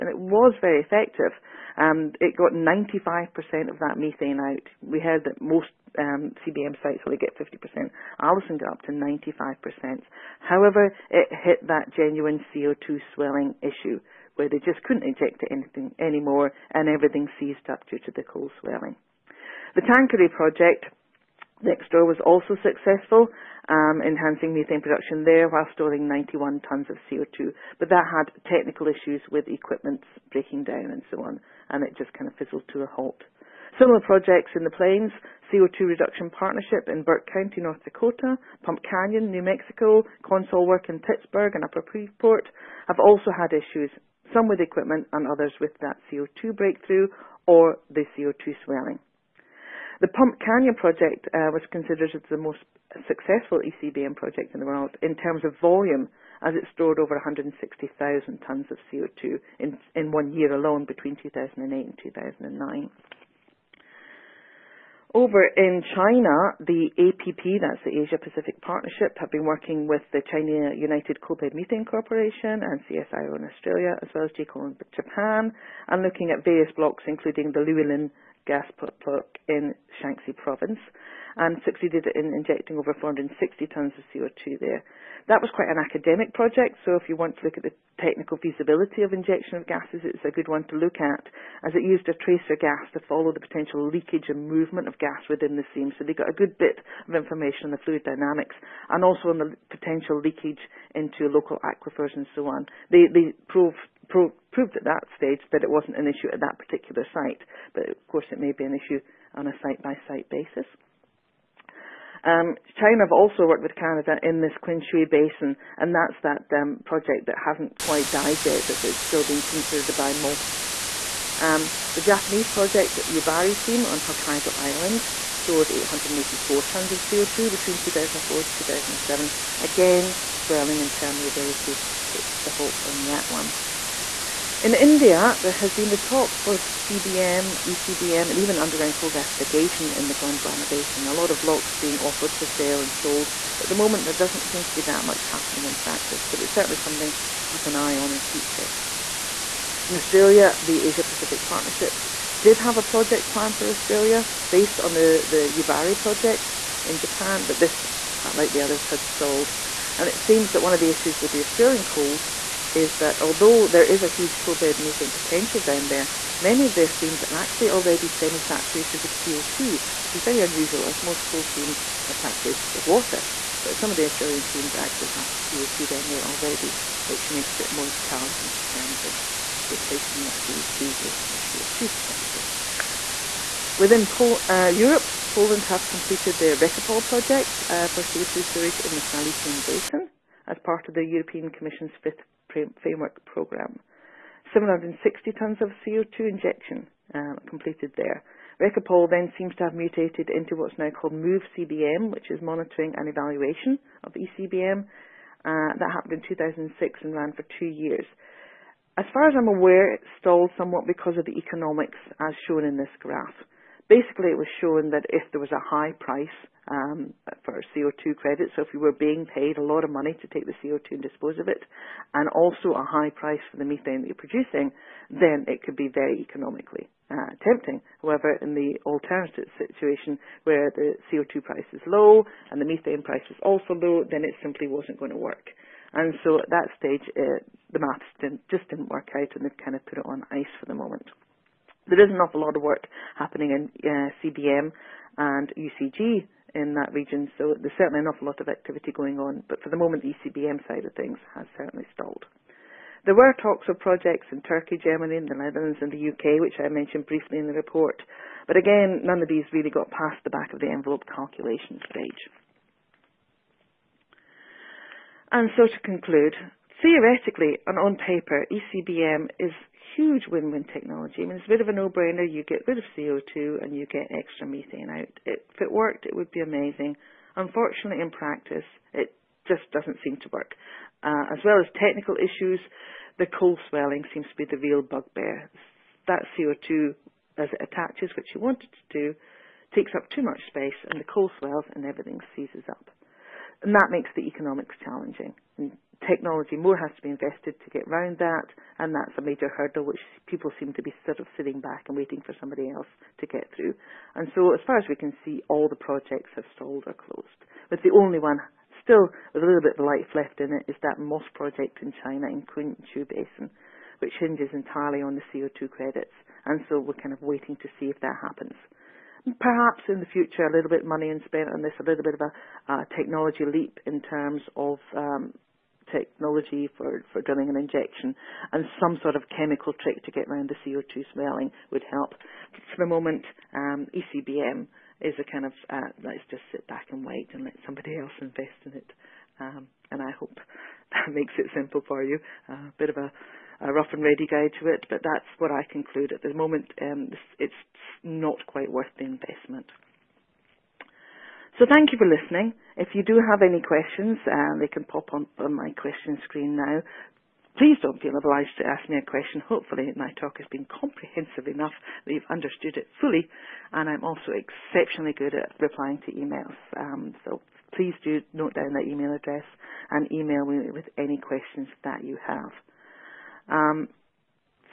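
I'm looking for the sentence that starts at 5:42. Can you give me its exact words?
A uh, bit of a, a, rough and ready guide to it, but that's what I conclude at the moment.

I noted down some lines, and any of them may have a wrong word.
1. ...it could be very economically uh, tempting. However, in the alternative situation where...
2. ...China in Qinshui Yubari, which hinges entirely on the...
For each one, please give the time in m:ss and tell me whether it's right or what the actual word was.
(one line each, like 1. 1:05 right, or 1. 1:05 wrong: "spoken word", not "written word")
1. 3:45 right
2. 5:12 wrong: "Basin", not "Yubari".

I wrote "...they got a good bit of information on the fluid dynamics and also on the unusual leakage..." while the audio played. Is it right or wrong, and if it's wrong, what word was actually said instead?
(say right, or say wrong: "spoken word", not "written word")
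wrong: "potential", not "unusual".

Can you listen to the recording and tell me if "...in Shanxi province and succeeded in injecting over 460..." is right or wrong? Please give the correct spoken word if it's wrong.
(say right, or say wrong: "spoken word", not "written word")
right.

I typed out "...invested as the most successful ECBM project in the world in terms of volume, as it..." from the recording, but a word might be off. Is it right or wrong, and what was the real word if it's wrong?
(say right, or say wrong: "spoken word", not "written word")
wrong: "considered", not "invested".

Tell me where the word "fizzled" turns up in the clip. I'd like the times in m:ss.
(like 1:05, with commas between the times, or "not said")
0:32.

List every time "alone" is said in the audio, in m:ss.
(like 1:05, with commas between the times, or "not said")
1:00.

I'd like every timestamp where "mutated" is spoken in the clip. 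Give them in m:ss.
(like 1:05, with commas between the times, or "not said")
3:19.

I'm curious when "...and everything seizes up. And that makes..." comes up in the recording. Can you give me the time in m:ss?
4:51.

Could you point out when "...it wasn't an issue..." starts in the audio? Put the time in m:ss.
1:45.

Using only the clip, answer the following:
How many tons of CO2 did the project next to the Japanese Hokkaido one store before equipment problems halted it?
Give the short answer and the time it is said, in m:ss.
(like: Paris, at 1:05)
91 tons, at 0:26.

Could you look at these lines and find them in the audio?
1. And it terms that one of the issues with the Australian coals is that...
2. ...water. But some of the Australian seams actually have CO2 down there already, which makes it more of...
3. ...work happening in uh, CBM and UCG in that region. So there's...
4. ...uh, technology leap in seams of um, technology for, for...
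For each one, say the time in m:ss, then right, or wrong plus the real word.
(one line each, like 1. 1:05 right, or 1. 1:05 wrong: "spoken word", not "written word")
1. 2:39 wrong: "seems", not "terms"
2. 2:52 right
3. 4:02 right
4. 5:22 wrong: "terms", not "seams".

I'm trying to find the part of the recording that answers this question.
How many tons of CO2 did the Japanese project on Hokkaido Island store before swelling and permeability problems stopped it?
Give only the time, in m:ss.
2:05.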